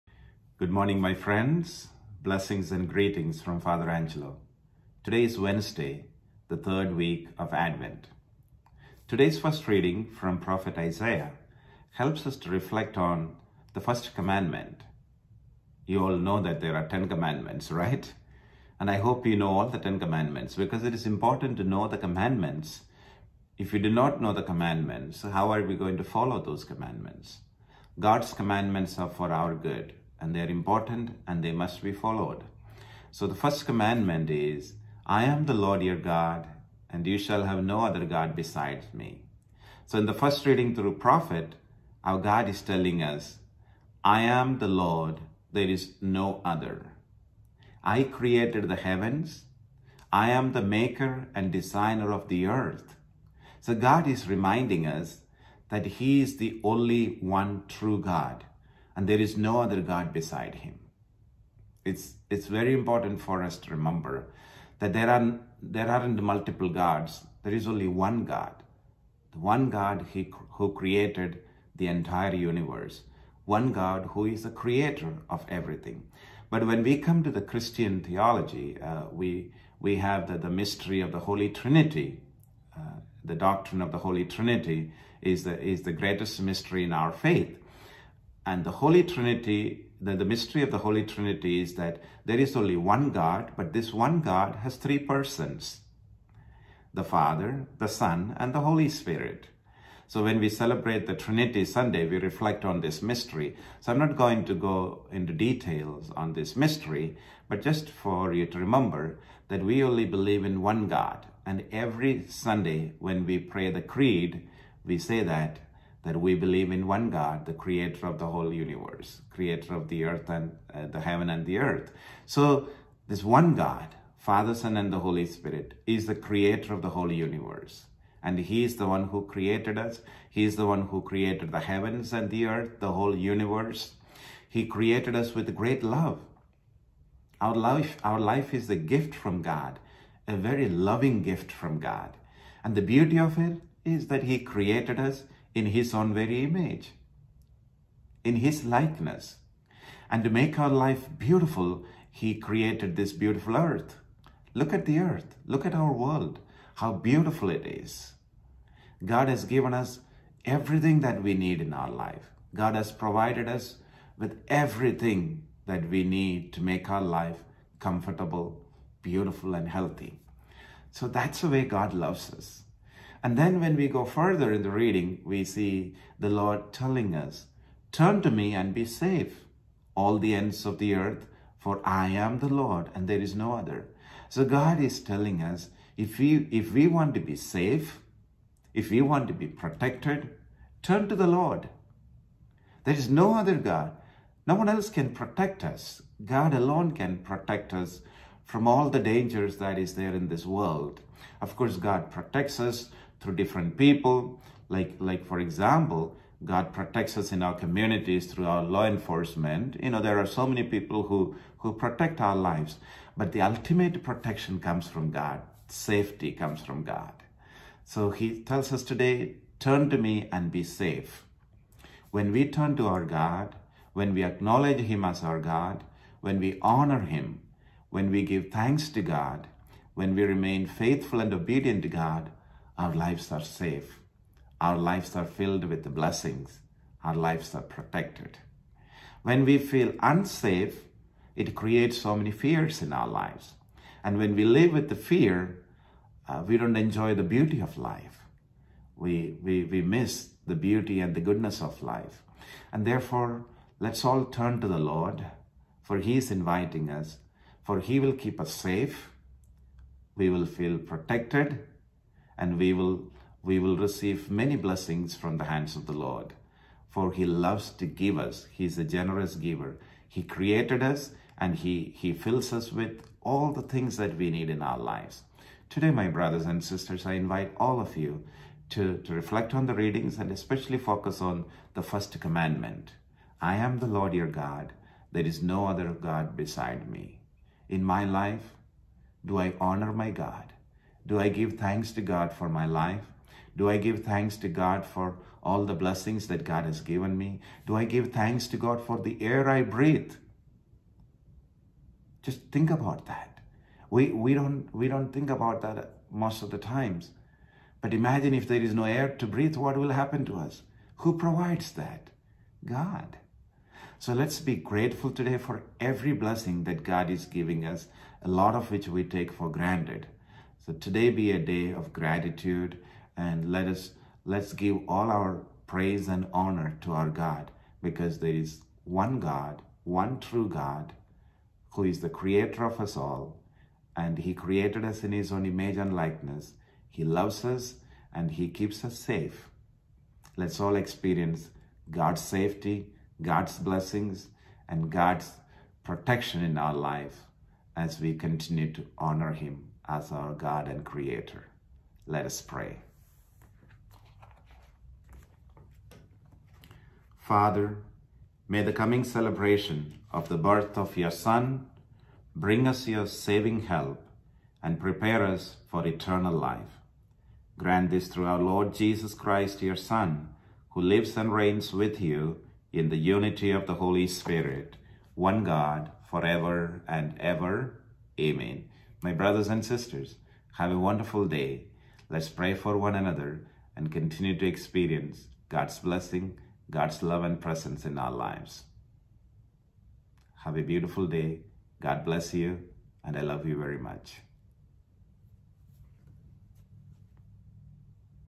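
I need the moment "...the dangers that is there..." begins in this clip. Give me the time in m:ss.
3:18.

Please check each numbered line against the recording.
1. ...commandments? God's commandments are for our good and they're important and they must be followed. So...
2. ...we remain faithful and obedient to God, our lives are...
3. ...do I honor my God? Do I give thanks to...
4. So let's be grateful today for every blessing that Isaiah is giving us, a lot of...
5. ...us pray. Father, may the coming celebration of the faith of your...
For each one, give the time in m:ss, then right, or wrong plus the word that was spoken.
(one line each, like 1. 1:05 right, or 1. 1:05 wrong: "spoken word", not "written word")
1. 0:26 right
2. 3:50 right
3. 4:49 right
4. 5:13 wrong: "God", not "Isaiah"
5. 5:52 wrong: "birth", not "faith".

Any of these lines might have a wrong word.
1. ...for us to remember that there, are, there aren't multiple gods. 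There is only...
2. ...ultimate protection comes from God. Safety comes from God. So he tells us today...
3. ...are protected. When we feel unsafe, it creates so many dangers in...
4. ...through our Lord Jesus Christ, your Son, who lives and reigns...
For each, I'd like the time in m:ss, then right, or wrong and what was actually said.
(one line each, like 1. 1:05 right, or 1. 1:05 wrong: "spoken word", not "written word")
1. 1:03 right
2. 3:33 right
3. 3:57 wrong: "fears", not "dangers"
4. 6:08 right.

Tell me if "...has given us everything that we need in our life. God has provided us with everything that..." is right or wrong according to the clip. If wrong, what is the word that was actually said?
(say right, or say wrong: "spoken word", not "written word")
right.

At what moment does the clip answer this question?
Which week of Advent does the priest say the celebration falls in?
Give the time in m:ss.
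0:06.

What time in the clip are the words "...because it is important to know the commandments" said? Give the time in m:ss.
0:20.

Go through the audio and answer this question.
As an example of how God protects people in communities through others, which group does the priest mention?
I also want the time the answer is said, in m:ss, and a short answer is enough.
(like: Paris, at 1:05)
Law enforcement, at 3:28.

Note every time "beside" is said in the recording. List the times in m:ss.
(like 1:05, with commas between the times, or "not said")
0:38, 1:00, 4:46.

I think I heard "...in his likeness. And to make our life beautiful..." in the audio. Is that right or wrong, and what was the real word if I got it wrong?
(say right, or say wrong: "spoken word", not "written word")
right.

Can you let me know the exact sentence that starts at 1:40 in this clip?
So when we celebrate the Trinity Sunday, we reflect on this mystery.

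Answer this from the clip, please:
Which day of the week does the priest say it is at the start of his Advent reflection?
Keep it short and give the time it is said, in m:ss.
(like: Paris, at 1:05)
Wednesday, at 0:05.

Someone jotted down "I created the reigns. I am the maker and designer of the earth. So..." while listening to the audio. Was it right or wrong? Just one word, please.
wrong.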